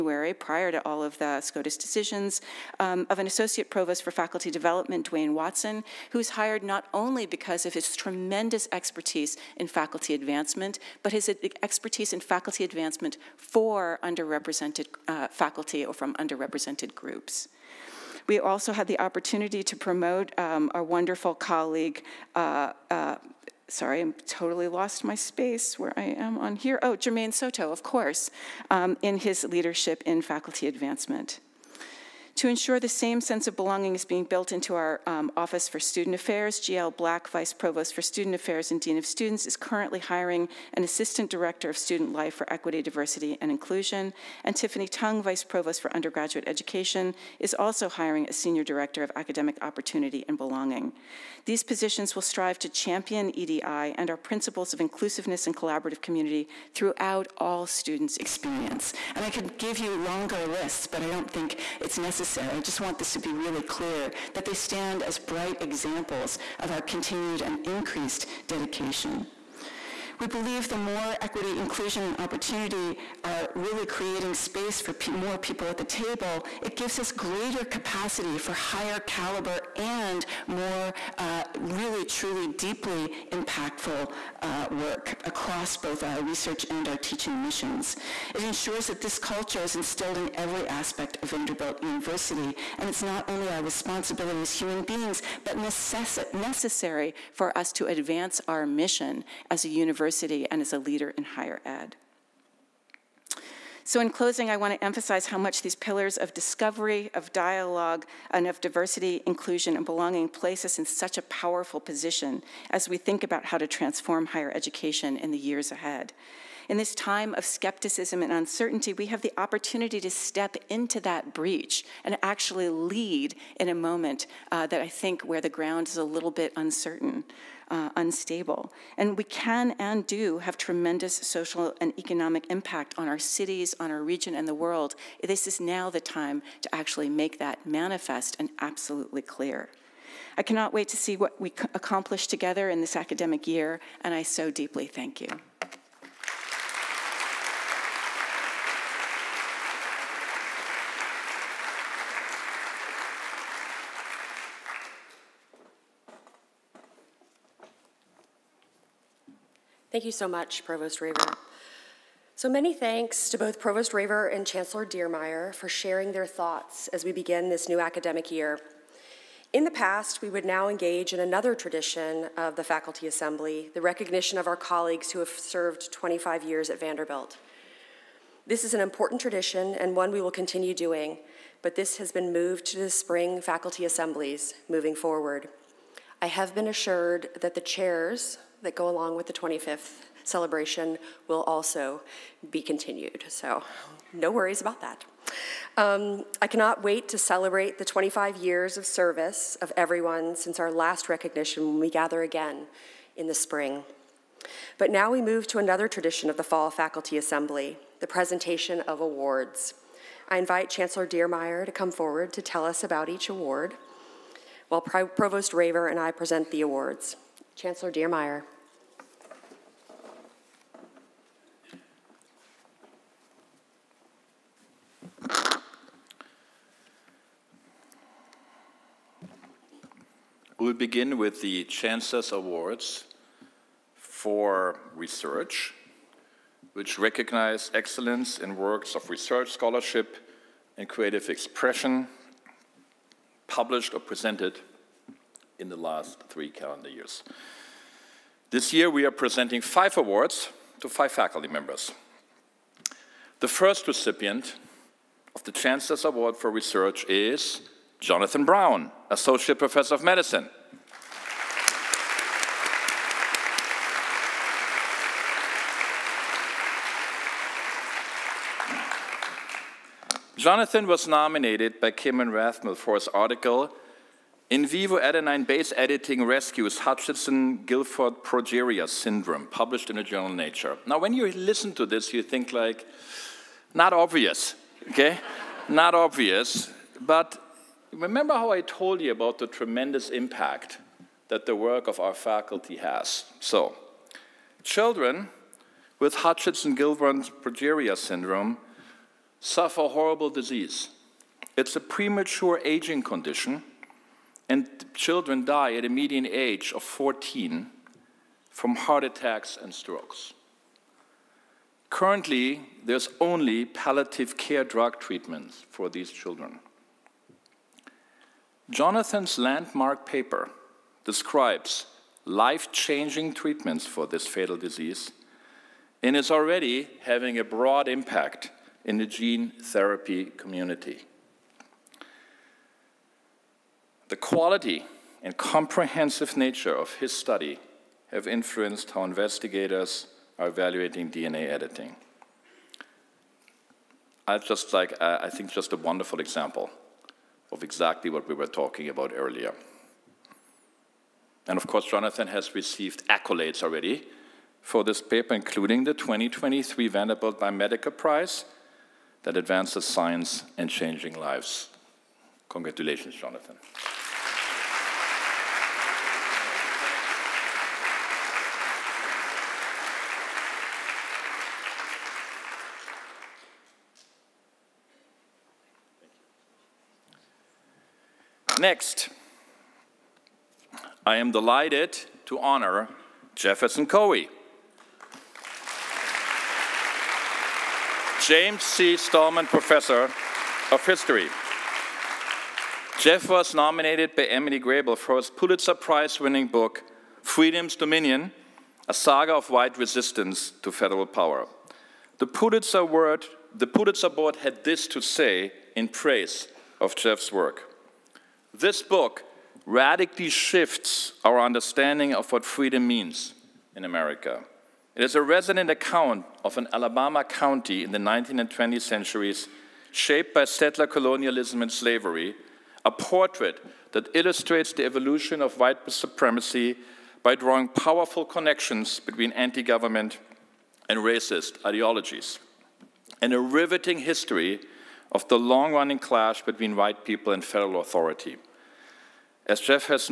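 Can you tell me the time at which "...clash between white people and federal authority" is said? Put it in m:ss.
7:15.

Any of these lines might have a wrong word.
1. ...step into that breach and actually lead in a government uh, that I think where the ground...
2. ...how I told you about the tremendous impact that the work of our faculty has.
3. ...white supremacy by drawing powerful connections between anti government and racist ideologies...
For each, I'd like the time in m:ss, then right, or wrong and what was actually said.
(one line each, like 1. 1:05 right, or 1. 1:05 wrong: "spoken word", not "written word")
1. 2:00 wrong: "moment", not "government"
2. 4:48 right
3. 7:05 right.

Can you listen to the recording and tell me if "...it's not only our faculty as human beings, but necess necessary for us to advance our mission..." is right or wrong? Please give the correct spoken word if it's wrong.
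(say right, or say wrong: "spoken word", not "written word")
wrong: "responsibility", not "faculty".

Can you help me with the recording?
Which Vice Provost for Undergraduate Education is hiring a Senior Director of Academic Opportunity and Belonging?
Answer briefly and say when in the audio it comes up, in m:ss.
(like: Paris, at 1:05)
Tiffany Tung, at 0:44.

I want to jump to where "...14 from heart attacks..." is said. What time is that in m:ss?
5:06.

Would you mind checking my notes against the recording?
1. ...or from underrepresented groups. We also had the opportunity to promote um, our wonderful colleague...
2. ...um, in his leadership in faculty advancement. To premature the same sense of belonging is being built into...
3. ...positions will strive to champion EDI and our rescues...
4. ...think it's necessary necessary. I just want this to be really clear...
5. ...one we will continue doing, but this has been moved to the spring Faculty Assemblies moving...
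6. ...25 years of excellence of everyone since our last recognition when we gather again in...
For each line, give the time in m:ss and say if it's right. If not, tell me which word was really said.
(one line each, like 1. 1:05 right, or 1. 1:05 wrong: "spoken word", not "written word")
1. 0:15 right
2. 0:28 wrong: "ensure", not "premature"
3. 0:51 wrong: "principles", not "rescues"
4. 1:01 right
5. 2:59 right
6. 3:17 wrong: "service", not "excellence".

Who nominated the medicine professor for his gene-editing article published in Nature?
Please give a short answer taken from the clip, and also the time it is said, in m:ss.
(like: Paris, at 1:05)
Kimryn Rathmell, at 4:31.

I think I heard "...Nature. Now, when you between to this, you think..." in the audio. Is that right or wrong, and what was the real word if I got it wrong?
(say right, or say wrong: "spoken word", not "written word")
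wrong: "listen", not "between".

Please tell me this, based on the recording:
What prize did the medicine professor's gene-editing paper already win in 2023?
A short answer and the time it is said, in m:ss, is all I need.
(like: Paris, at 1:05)
Vanderbilt Biomedical Prize, at 5:56.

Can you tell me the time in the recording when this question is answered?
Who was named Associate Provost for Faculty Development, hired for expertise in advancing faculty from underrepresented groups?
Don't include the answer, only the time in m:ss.
0:05.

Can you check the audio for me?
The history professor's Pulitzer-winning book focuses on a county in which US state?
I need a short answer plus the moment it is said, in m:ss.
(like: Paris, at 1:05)
Alabama, at 6:56.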